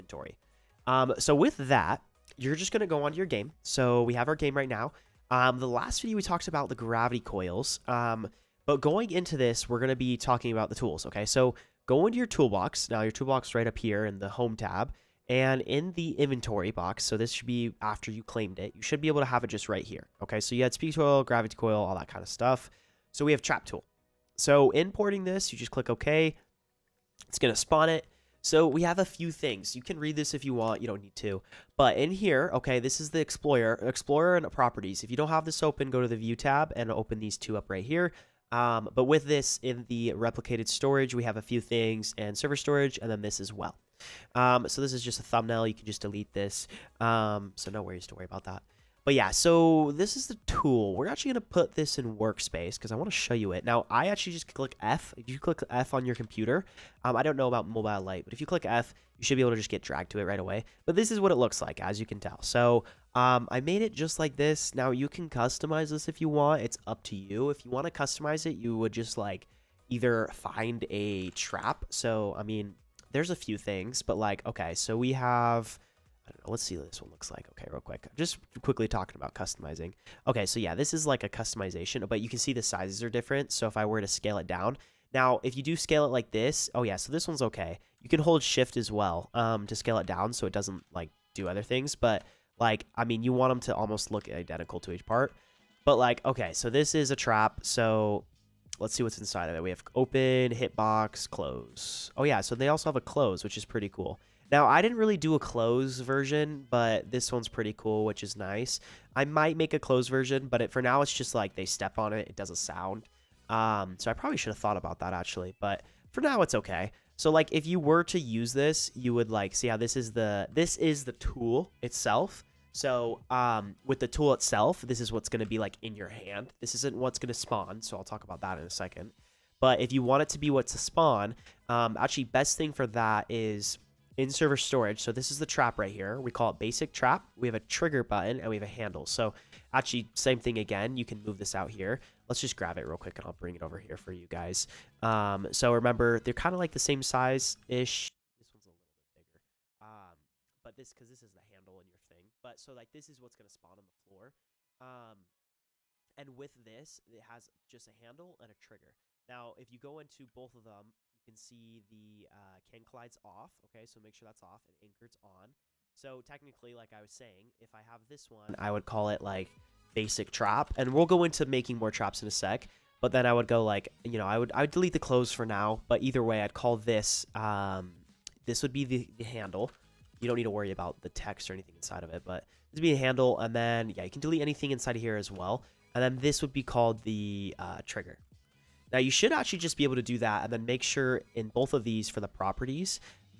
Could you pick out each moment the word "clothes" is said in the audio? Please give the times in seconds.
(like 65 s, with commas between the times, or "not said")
174 s.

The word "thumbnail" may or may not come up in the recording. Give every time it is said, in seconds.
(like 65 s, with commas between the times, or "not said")
45 s.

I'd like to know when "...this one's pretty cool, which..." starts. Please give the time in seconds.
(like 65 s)
107 s.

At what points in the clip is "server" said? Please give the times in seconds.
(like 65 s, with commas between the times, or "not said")
42 s, 134 s.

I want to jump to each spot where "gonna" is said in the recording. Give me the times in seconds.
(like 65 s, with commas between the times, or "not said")
2 s, 9 s.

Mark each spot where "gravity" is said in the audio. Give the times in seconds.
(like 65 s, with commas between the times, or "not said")
6 s, 21 s.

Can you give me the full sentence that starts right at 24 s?
So importing this, you just click OK.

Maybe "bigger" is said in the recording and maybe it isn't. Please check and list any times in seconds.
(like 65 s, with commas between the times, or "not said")
149 s.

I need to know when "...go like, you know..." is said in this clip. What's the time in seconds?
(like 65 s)
173 s.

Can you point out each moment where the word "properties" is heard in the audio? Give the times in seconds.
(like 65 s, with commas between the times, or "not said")
34 s, 192 s.